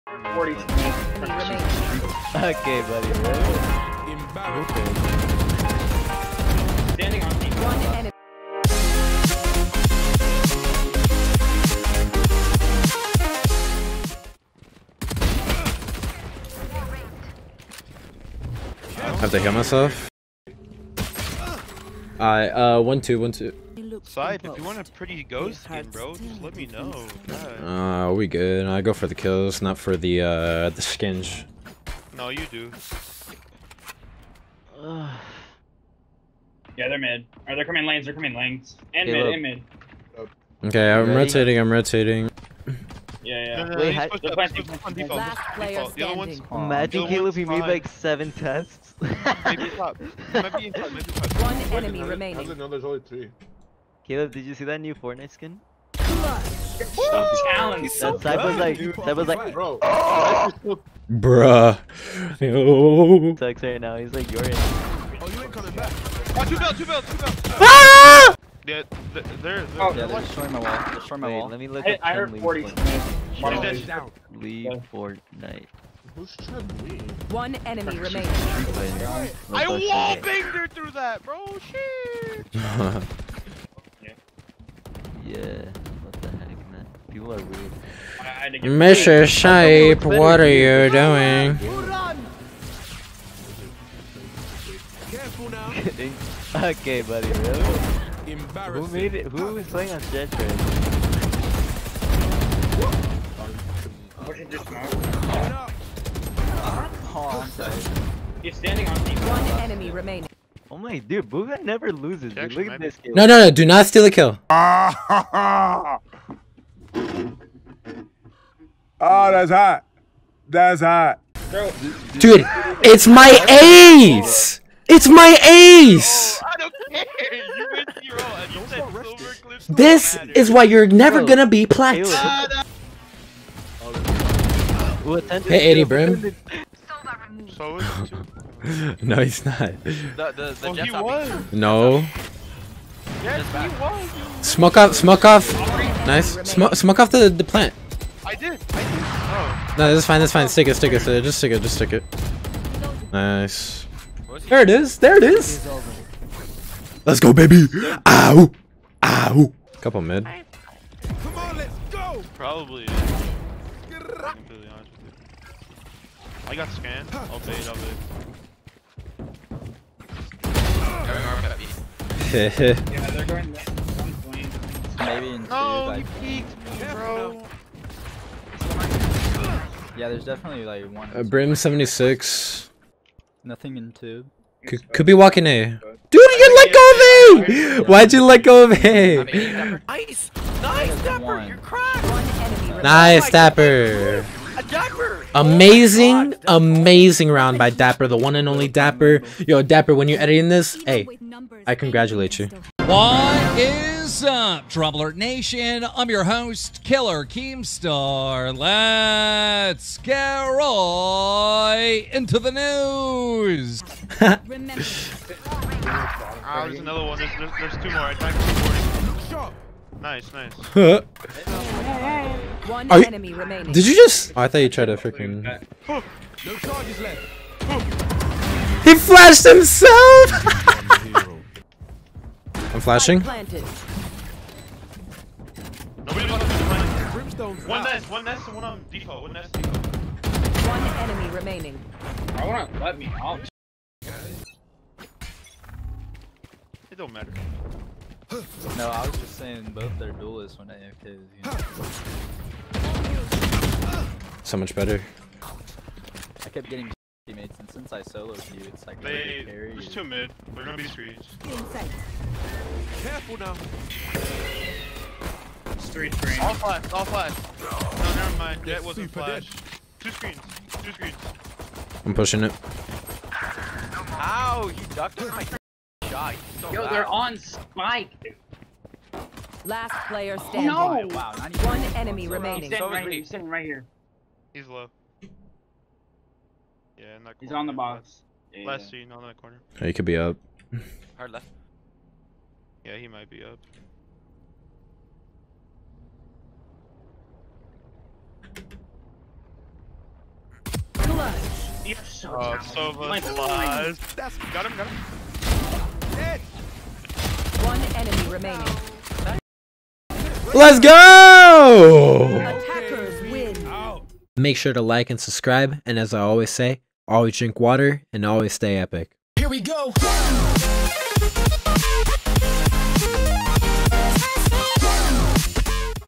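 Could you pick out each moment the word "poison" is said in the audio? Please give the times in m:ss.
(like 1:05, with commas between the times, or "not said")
not said.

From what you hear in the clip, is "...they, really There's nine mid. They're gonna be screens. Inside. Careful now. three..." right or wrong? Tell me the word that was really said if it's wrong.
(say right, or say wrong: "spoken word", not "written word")
wrong: "two", not "nine".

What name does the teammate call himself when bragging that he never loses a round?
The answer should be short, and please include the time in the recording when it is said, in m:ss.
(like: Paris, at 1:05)
Booga, at 1:51.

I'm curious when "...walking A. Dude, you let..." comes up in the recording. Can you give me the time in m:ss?
3:05.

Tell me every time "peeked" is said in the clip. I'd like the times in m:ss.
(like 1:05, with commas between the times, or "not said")
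2:56.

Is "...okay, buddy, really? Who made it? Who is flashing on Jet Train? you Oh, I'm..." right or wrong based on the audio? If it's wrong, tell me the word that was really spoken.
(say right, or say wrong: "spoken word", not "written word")
wrong: "playing", not "flashing".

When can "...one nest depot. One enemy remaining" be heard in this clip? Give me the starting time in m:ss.
3:59.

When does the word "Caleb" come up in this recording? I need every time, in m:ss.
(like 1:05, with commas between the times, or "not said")
0:47, 0:54.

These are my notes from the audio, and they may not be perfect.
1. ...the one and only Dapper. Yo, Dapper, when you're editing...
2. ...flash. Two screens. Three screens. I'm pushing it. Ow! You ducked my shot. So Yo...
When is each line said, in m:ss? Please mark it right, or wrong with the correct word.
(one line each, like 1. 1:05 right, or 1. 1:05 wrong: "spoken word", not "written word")
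1. 3:18 right
2. 4:29 wrong: "Two", not "Three".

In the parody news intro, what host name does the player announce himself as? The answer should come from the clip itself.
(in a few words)
Killer Keemstar.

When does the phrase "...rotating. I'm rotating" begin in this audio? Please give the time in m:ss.
0:41.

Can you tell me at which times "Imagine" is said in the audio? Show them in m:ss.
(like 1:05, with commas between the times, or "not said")
0:46.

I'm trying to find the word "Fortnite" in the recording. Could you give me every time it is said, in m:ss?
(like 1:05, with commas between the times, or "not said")
0:54, 1:14.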